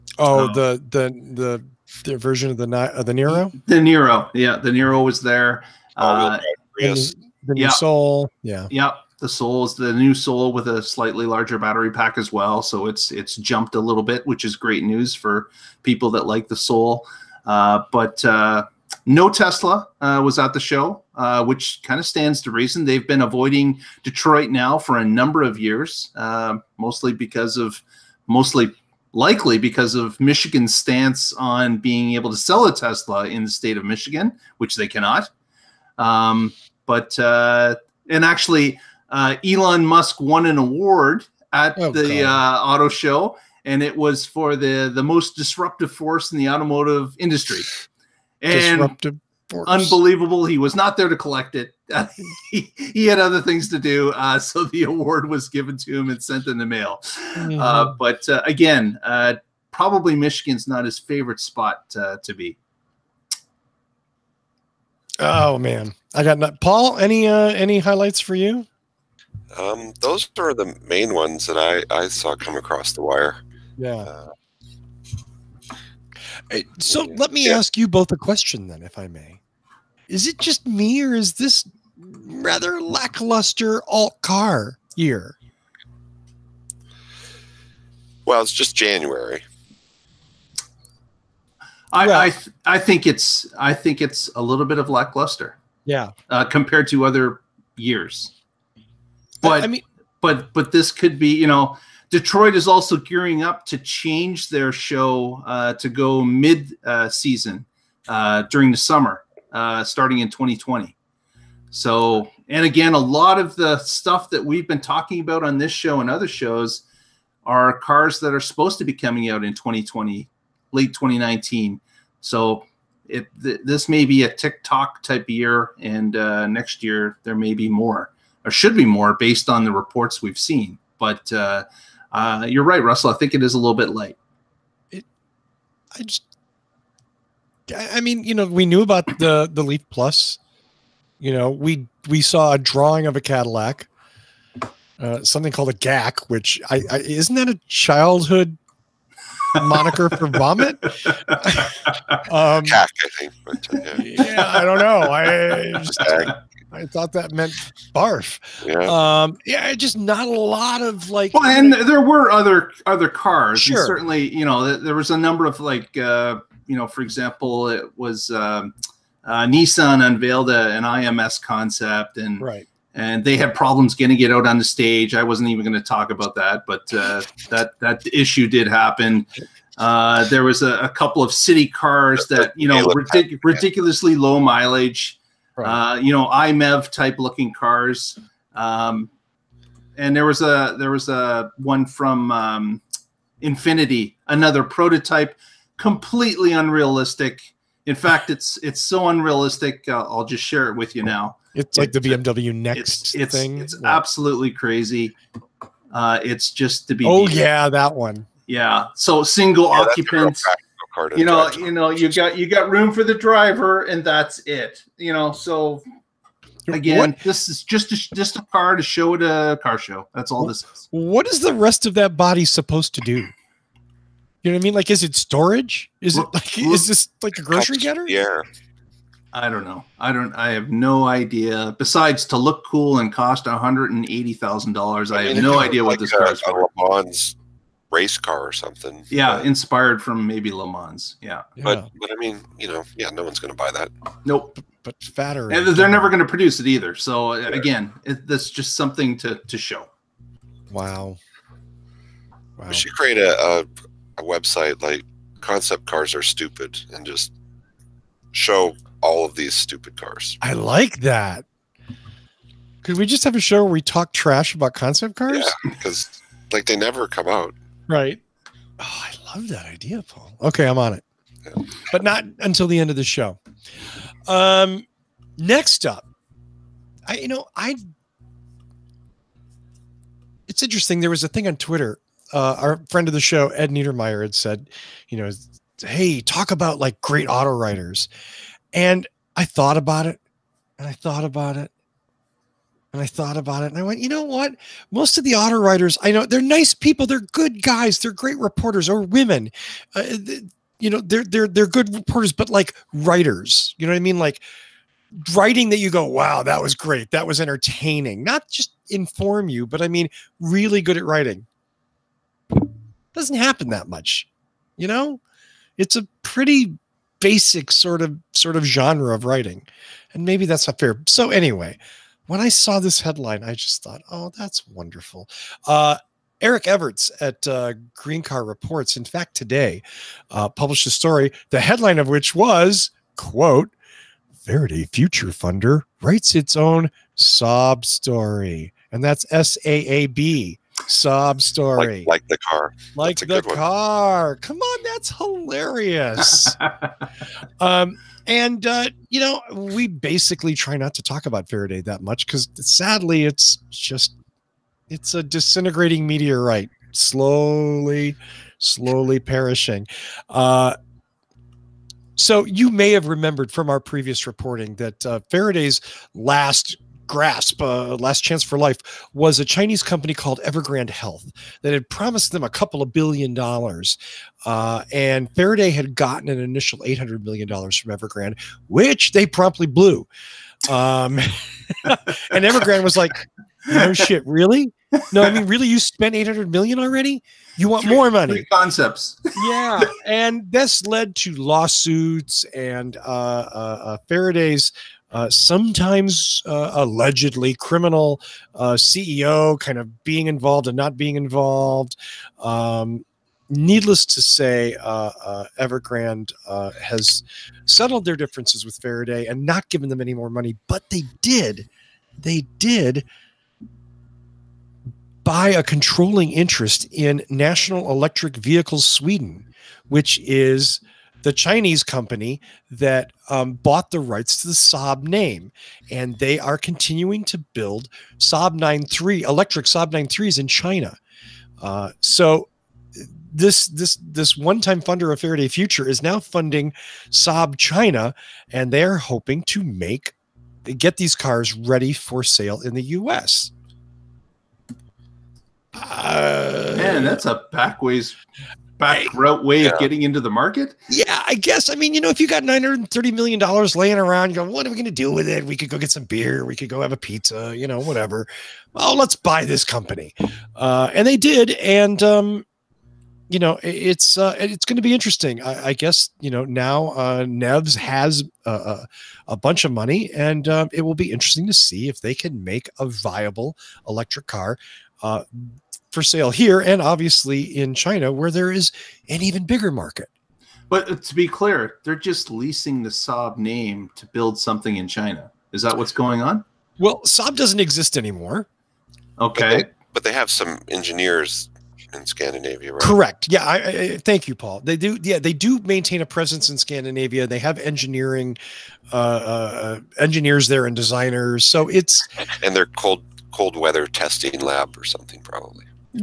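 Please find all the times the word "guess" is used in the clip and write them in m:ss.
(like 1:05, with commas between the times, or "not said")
7:31, 7:45.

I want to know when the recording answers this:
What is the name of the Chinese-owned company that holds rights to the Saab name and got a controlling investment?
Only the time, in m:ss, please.
6:57.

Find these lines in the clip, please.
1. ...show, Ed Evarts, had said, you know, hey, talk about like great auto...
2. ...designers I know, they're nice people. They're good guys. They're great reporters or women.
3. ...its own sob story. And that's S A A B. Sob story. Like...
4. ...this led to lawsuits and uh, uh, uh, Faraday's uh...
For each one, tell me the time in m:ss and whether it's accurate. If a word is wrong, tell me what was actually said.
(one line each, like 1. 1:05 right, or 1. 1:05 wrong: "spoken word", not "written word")
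1. 4:43 wrong: "Niedermeyer", not "Evarts"
2. 4:55 wrong: "writers", not "designers"
3. 5:36 right
4. 6:30 right.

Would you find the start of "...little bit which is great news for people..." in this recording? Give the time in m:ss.
0:13.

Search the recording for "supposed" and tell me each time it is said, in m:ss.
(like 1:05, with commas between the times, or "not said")
1:58, 3:42.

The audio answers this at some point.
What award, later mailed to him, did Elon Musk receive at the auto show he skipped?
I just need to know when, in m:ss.
0:45.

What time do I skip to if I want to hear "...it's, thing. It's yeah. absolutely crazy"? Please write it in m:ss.
3:23.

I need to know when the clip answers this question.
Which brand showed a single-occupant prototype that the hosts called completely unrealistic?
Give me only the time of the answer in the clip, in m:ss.
3:13.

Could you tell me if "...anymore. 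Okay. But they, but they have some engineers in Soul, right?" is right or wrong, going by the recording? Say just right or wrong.
wrong.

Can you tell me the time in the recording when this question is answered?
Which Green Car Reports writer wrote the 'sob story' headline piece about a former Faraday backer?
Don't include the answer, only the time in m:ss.
5:26.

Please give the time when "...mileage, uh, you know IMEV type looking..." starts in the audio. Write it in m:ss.
3:04.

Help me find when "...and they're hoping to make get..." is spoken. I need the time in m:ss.
7:18.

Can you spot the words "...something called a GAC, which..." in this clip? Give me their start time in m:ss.
2:25.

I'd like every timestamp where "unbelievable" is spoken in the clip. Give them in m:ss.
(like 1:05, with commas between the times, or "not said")
0:49.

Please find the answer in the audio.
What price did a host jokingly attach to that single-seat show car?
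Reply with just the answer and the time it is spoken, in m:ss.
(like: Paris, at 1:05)
$180,000, at 3:53.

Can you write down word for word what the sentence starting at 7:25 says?
Uh, Man, that's a backways Back route way yeah.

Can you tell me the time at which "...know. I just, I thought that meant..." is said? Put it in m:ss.
2:34.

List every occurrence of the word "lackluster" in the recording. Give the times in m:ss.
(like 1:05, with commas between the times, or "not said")
1:22, 1:34.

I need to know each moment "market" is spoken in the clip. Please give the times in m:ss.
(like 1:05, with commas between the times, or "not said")
7:30, 7:59.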